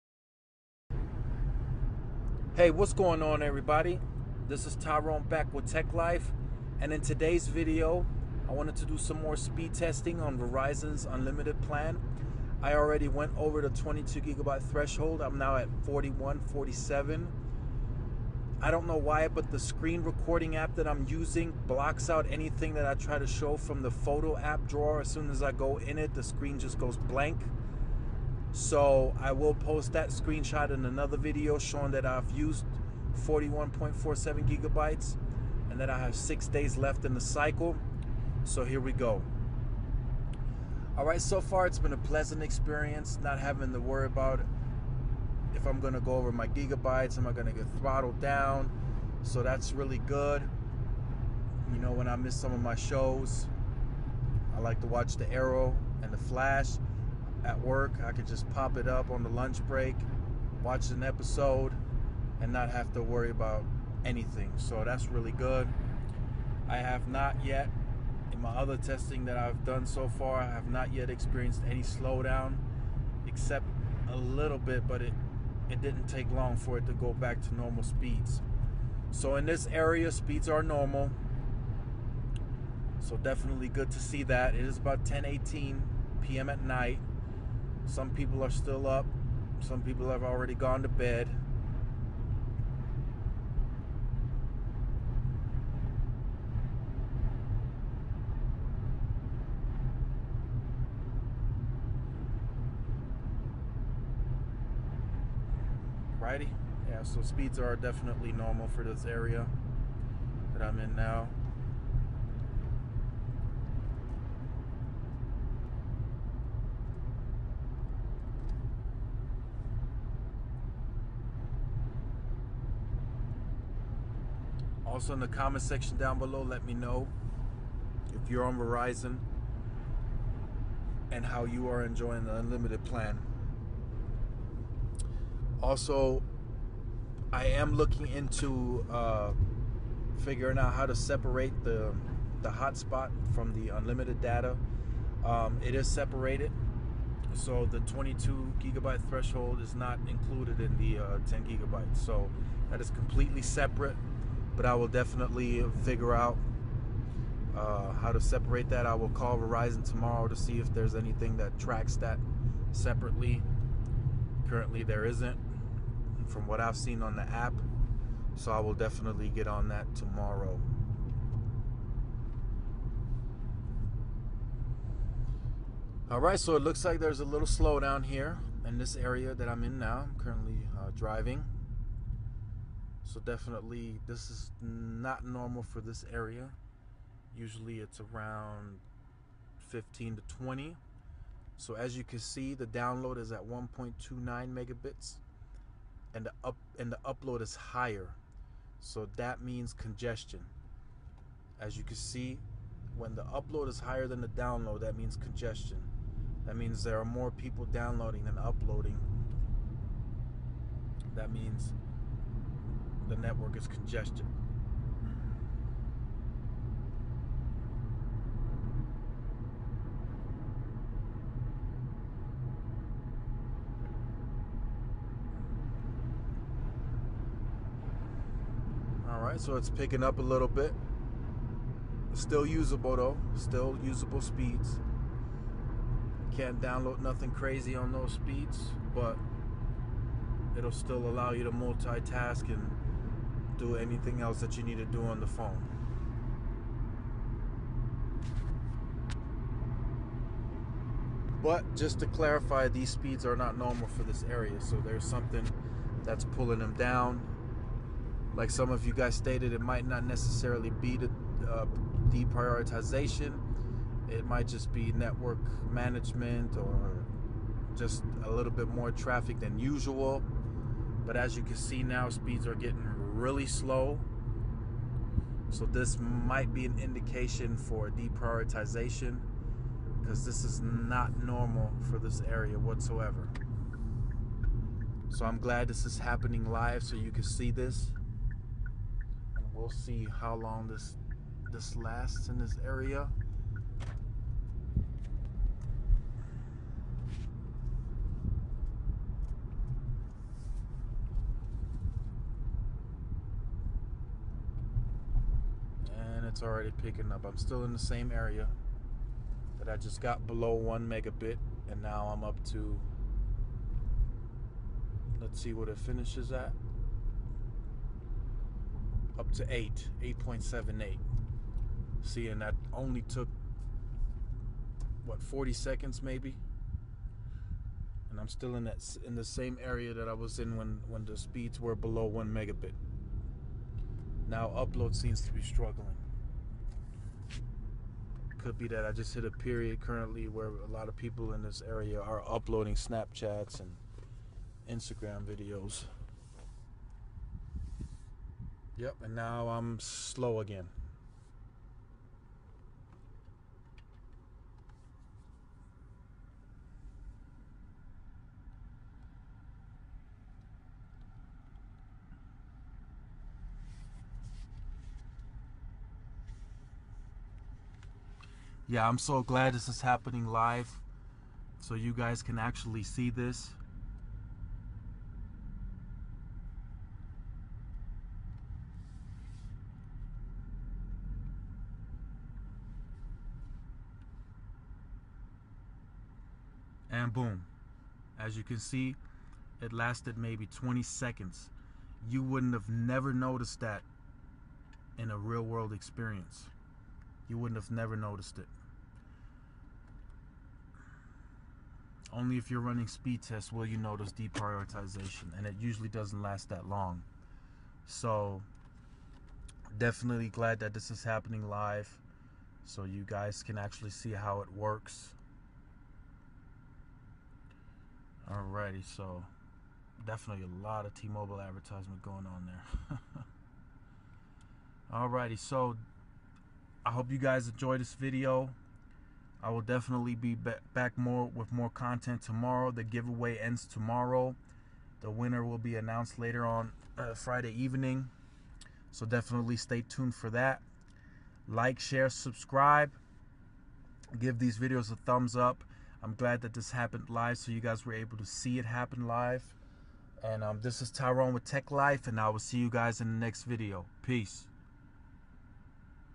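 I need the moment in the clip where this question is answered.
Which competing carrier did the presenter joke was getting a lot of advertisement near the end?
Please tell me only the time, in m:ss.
7:00.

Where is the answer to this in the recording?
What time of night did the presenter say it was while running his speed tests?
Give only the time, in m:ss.
1:25.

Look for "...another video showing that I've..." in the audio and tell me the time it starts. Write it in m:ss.
0:30.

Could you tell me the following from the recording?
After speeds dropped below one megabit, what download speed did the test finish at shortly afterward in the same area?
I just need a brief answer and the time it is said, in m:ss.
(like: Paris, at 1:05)
8.78, at 5:20.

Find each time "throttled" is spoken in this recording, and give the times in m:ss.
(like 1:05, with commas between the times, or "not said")
0:47.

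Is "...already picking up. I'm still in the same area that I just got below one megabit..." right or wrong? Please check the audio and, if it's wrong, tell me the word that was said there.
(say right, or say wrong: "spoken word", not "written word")
right.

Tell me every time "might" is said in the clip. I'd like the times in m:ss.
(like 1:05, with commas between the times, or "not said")
4:19, 4:24, 4:35.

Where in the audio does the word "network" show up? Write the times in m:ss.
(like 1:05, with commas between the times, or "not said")
3:33, 4:24.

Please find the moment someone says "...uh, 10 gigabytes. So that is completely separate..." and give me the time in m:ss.
2:31.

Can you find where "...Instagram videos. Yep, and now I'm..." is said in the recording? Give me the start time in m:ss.
5:44.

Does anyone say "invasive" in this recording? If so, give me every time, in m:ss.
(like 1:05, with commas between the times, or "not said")
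not said.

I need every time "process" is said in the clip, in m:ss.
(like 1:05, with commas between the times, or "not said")
not said.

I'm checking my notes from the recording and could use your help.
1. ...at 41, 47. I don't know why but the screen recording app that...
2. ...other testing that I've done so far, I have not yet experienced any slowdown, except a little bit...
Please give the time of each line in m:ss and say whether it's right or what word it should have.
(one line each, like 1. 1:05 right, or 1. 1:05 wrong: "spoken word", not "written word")
1. 0:15 right
2. 1:08 right.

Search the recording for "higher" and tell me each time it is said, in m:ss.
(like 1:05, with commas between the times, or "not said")
3:17, 3:23.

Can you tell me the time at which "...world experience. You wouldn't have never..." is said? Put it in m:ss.
6:35.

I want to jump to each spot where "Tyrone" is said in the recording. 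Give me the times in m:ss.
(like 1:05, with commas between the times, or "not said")
0:04, 7:30.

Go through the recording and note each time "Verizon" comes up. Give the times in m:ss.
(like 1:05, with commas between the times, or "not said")
0:10, 2:08, 2:39.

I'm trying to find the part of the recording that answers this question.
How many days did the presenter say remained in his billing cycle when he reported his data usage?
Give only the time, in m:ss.
0:36.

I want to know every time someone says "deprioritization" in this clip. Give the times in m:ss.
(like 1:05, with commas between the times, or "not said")
4:22, 4:37, 6:44.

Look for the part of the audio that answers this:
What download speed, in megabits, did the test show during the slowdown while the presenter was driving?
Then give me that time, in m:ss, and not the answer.
3:13.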